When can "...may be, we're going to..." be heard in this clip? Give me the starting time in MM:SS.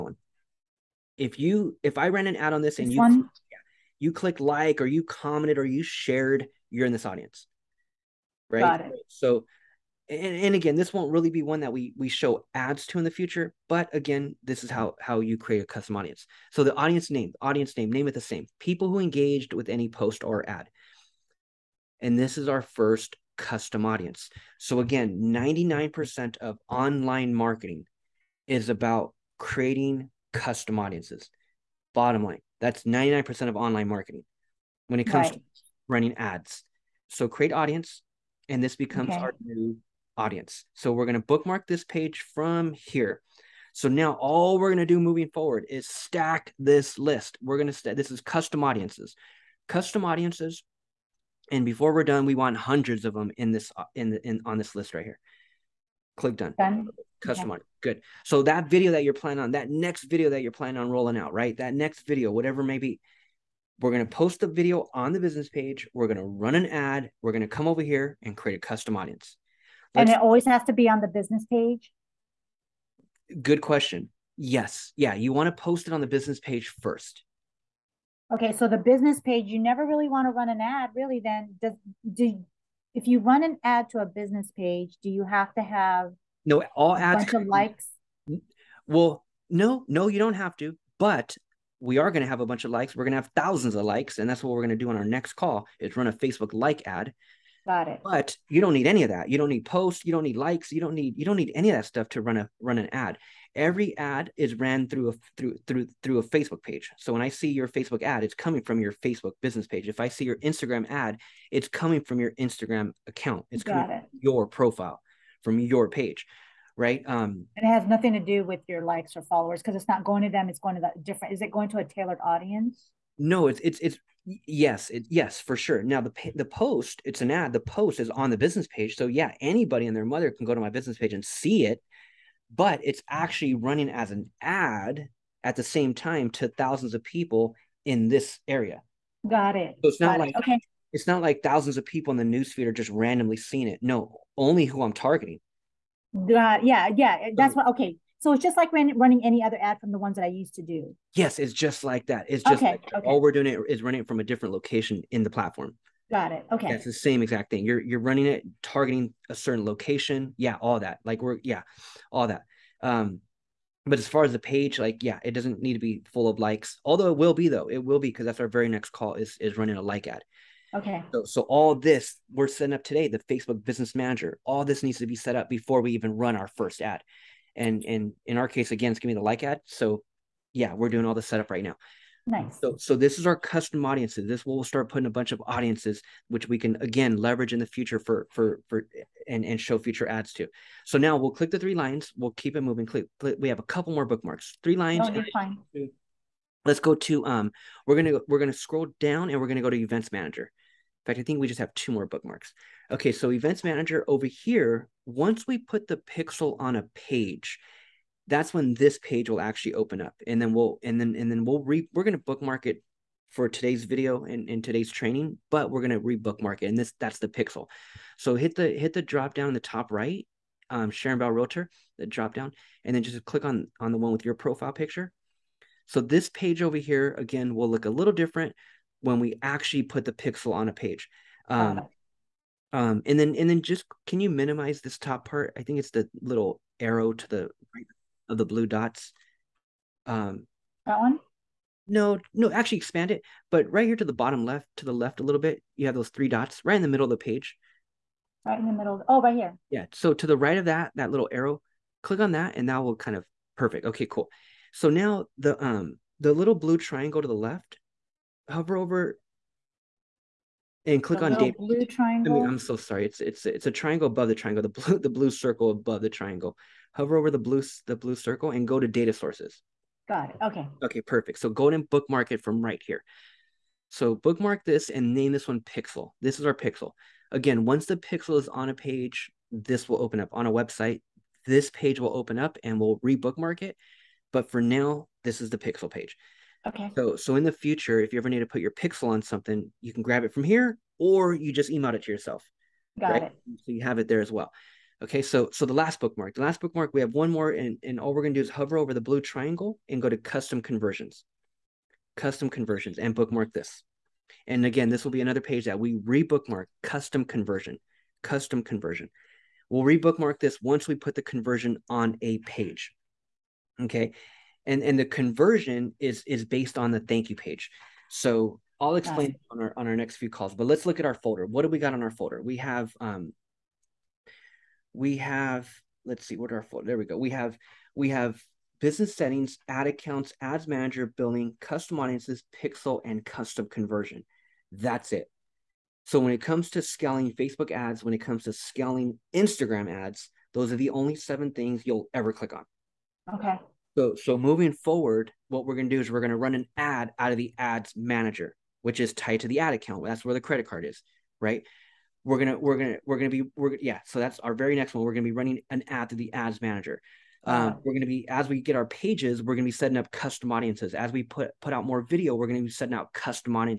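01:02.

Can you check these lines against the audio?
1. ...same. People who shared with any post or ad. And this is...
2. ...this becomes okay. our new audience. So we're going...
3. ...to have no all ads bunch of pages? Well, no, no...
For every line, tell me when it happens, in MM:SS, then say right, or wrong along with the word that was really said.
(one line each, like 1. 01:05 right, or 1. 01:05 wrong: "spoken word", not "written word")
1. 00:18 wrong: "engaged", not "shared"
2. 00:38 right
3. 01:25 wrong: "likes", not "pages".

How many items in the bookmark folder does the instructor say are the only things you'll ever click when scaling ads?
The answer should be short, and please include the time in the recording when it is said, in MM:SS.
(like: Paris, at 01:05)
7, at 05:41.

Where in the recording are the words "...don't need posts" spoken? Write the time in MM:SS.
01:39.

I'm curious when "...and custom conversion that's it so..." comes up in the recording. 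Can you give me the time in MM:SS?
05:33.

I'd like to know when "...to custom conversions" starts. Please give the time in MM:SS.
05:00.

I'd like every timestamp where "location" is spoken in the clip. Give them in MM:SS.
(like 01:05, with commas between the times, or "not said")
02:34, 02:39.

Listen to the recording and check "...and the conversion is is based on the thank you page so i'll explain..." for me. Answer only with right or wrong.
right.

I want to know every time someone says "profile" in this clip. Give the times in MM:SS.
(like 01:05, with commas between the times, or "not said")
01:54, 03:44.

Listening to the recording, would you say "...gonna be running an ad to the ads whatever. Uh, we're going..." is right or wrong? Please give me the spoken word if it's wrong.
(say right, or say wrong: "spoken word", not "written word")
wrong: "manager", not "whatever".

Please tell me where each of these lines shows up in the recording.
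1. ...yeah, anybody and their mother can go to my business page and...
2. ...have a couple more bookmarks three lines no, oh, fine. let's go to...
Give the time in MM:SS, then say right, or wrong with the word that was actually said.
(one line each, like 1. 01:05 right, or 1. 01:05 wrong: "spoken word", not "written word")
1. 02:09 right
2. 03:13 right.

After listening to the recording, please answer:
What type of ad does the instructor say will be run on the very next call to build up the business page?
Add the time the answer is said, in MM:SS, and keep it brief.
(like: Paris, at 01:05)
A Facebook like ad, at 01:36.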